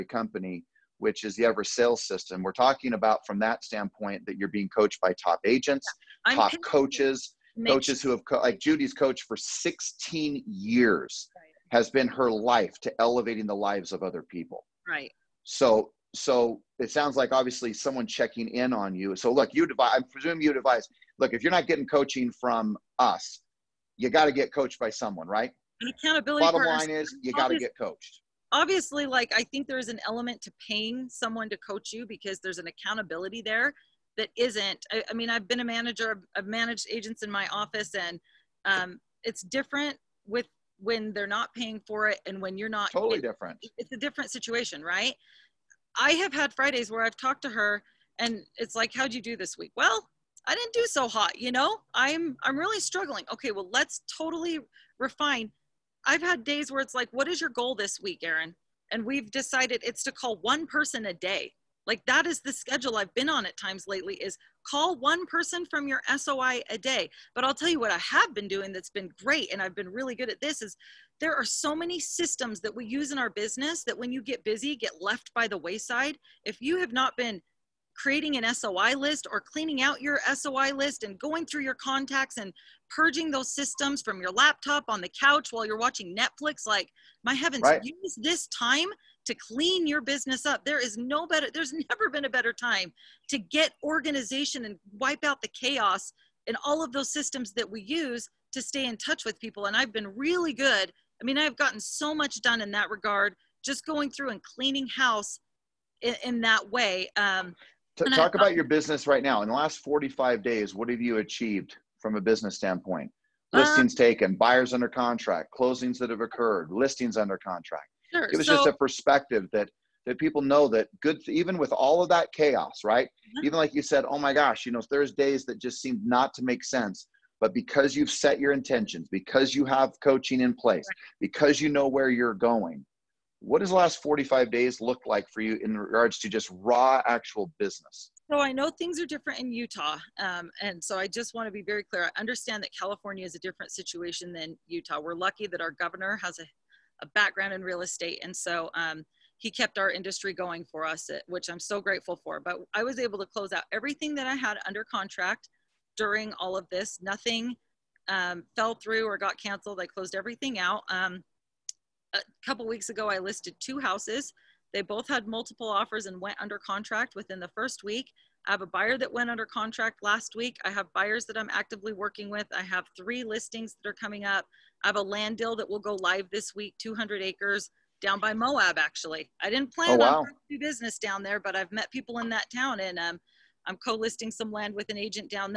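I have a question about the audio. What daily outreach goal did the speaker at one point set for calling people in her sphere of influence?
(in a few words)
One person a day.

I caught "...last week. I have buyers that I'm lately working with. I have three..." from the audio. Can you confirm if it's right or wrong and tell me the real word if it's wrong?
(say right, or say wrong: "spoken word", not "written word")
wrong: "actively", not "lately".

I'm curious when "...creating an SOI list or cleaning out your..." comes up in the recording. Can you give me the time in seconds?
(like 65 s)
77 s.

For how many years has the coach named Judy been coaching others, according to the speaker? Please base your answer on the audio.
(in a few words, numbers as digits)
16 years.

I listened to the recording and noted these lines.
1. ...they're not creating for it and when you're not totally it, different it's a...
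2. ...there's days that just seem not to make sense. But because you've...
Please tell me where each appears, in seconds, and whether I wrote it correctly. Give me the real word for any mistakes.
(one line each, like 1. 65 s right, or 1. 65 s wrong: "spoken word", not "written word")
1. 41 s wrong: "paying", not "creating"
2. 124 s right.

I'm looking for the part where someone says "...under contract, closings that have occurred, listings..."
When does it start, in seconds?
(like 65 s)
114 s.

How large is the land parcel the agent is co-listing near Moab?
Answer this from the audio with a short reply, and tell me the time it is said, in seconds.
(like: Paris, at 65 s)
200 acres, at 176 s.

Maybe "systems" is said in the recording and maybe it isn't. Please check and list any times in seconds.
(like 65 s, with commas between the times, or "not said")
2 s, 71 s, 83 s, 97 s.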